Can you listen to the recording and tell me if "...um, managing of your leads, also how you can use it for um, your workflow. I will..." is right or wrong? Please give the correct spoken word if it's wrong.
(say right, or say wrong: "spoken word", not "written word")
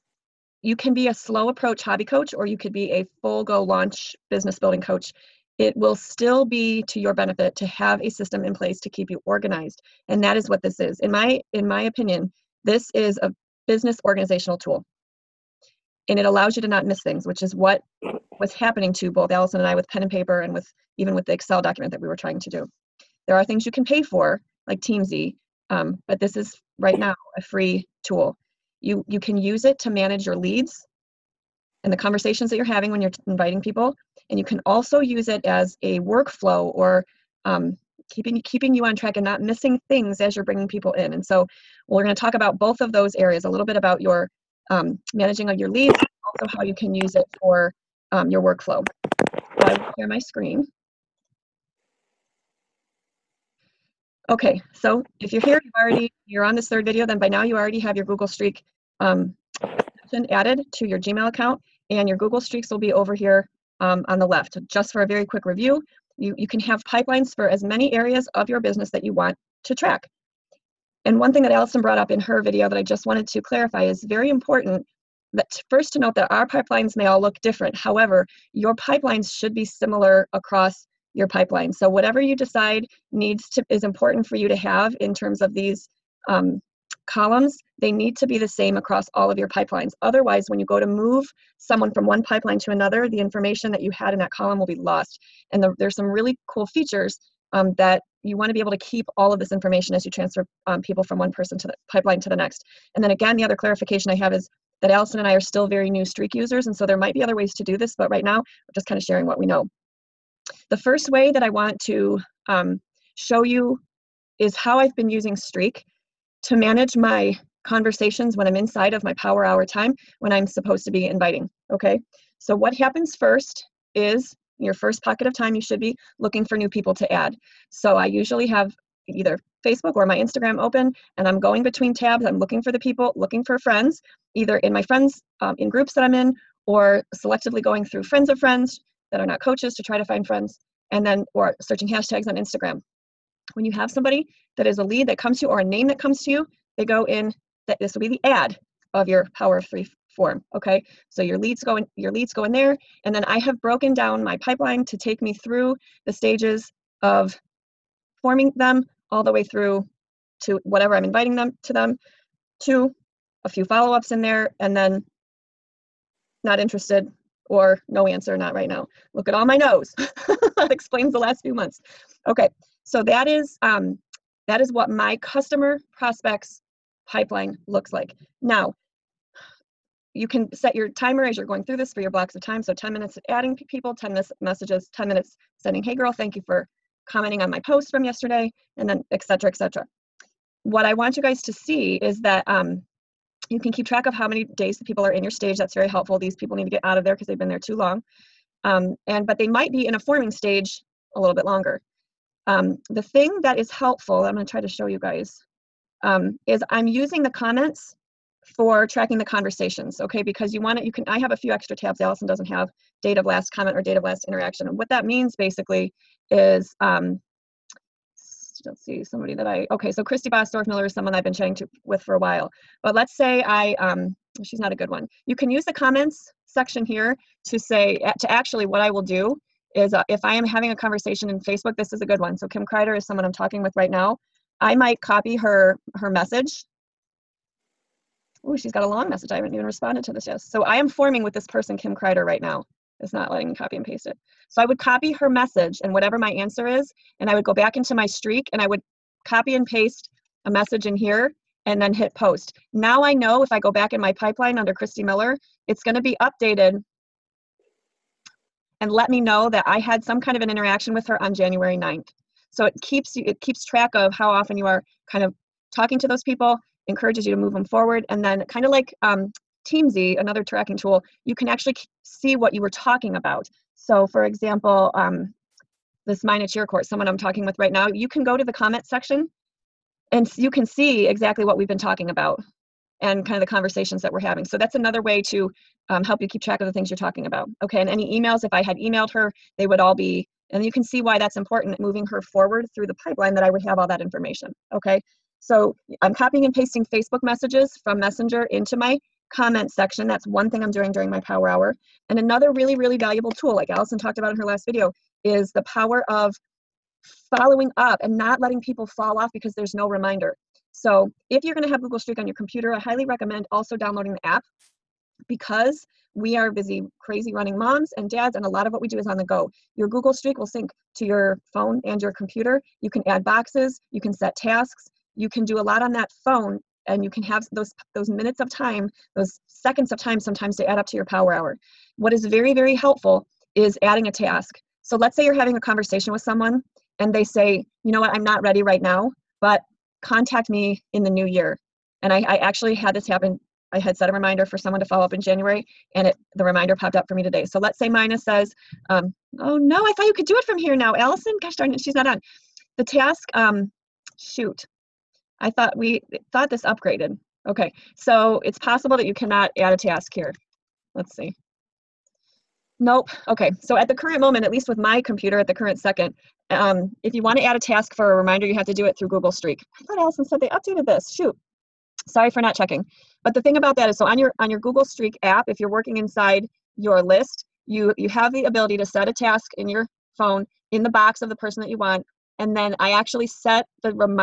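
right.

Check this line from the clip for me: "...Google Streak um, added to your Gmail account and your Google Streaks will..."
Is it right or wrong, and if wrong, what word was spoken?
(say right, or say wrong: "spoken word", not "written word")
right.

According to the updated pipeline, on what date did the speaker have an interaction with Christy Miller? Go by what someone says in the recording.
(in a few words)
January 9th.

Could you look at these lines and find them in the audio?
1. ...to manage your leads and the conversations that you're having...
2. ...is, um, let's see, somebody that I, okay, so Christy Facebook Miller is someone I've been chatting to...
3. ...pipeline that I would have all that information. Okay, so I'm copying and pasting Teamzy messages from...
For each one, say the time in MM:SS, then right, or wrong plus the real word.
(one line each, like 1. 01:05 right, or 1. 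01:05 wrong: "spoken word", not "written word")
1. 00:29 right
2. 03:36 wrong: "Bostorf", not "Facebook"
3. 04:53 wrong: "Facebook", not "Teamzy".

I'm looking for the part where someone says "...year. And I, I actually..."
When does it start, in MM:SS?
05:41.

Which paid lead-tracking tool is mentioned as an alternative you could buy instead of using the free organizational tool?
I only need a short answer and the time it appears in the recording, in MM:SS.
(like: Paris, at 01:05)
Teamzy, at 00:24.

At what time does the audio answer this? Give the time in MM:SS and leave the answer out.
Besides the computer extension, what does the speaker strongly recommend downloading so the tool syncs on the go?
05:14.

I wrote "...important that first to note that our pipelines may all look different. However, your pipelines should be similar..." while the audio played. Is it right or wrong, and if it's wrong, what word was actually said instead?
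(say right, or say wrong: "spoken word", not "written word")
right.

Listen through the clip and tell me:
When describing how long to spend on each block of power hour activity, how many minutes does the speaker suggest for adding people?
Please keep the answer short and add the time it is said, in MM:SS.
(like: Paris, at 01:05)
10, at 03:02.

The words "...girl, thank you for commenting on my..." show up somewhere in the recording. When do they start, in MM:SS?
03:05.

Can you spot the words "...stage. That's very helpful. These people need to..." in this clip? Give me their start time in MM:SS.
03:15.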